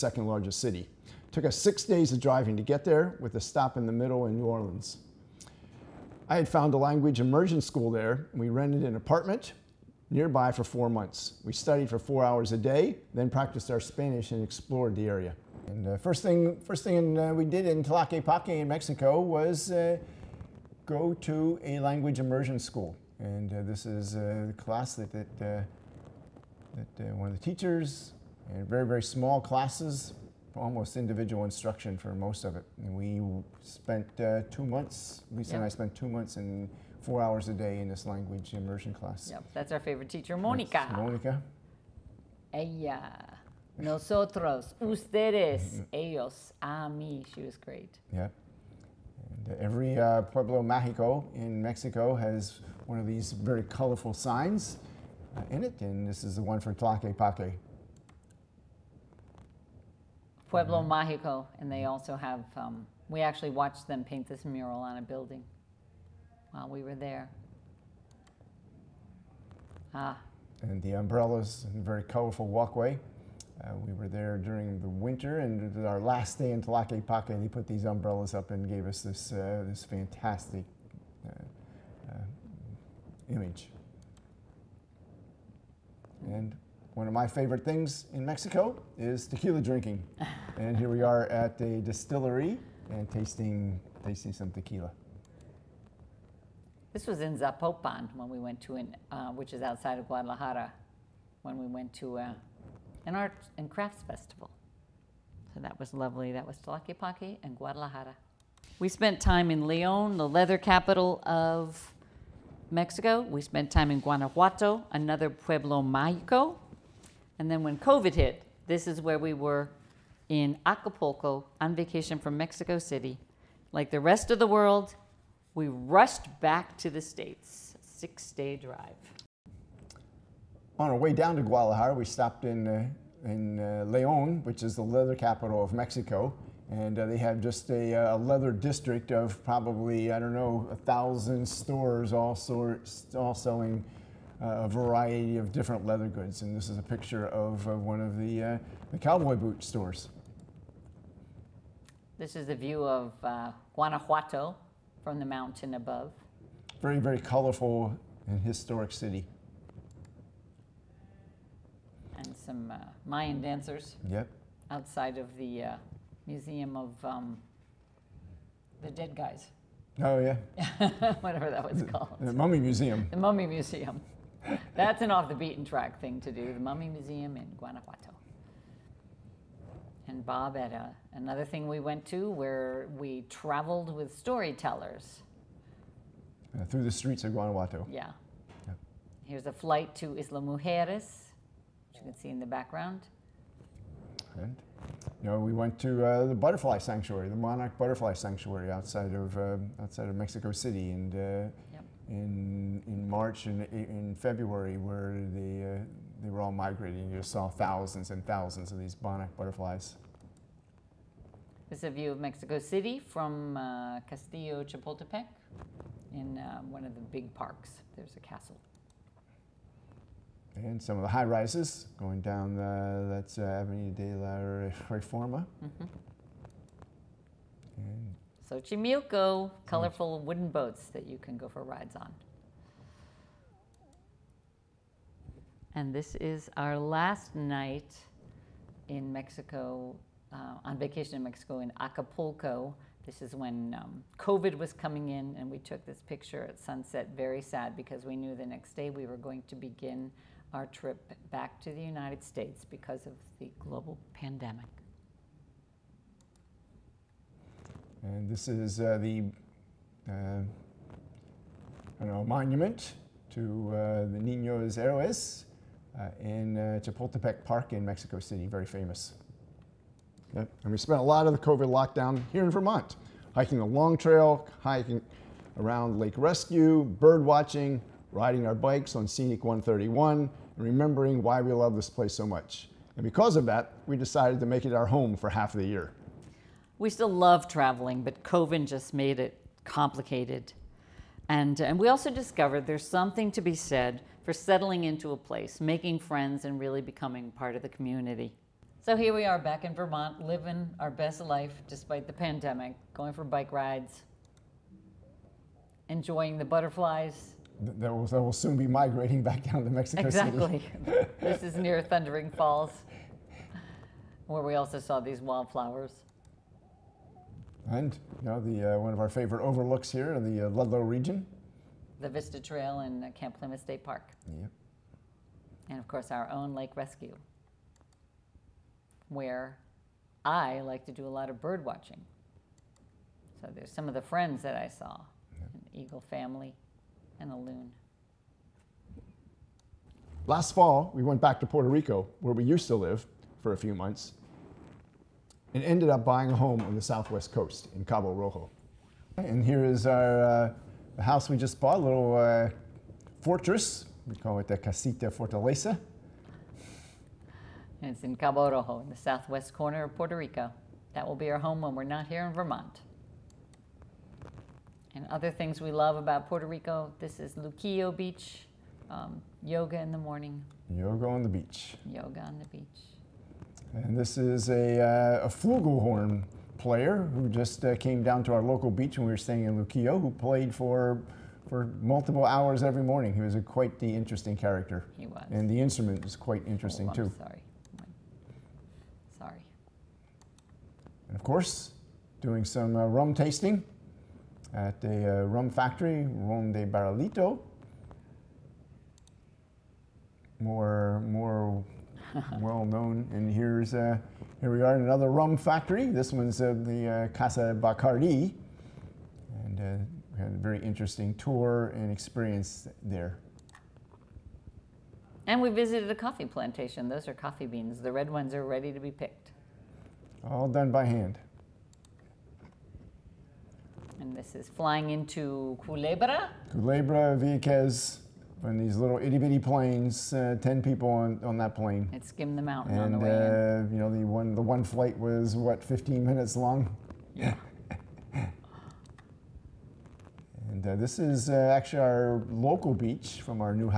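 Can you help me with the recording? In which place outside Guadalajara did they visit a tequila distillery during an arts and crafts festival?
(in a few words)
Zapopan.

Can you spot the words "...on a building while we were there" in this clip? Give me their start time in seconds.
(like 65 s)
64 s.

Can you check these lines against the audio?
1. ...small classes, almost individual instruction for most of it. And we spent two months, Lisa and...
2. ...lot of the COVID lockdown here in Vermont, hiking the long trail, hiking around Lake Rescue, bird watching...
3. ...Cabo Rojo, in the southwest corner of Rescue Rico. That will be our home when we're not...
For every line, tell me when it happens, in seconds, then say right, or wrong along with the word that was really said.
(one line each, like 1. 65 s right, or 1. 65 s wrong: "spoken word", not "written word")
1. 29 s right
2. 271 s right
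3. 358 s wrong: "Puerto", not "Rescue".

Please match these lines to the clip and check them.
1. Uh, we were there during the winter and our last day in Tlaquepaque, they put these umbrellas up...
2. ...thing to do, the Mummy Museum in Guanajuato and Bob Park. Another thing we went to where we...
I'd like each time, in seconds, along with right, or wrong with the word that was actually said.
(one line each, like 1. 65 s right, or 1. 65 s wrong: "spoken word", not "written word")
1. 73 s right
2. 176 s wrong: "Etta", not "Park".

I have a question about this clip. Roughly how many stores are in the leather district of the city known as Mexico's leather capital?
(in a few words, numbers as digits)
1000.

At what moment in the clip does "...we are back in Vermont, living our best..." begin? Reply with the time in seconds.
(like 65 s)
299 s.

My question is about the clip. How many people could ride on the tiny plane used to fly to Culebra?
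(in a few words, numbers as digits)
10.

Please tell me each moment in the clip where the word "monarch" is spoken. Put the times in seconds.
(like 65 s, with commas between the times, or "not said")
197 s, 209 s.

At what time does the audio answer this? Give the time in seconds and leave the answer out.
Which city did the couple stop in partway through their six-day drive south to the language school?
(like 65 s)
4 s.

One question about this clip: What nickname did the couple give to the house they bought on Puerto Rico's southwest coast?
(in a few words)
Casita Fortaleza.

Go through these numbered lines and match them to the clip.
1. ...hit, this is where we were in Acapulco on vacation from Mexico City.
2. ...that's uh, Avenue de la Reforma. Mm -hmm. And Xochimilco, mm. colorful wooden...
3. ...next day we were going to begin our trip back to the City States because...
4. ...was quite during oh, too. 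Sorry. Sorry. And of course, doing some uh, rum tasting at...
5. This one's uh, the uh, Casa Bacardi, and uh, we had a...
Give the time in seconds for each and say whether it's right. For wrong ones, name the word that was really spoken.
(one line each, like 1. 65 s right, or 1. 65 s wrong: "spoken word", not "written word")
1. 118 s right
2. 223 s right
3. 248 s wrong: "United", not "City"
4. 386 s wrong: "interesting", not "during"
5. 405 s right.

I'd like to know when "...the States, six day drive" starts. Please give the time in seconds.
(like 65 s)
126 s.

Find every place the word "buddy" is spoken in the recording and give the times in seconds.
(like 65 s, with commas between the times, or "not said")
not said.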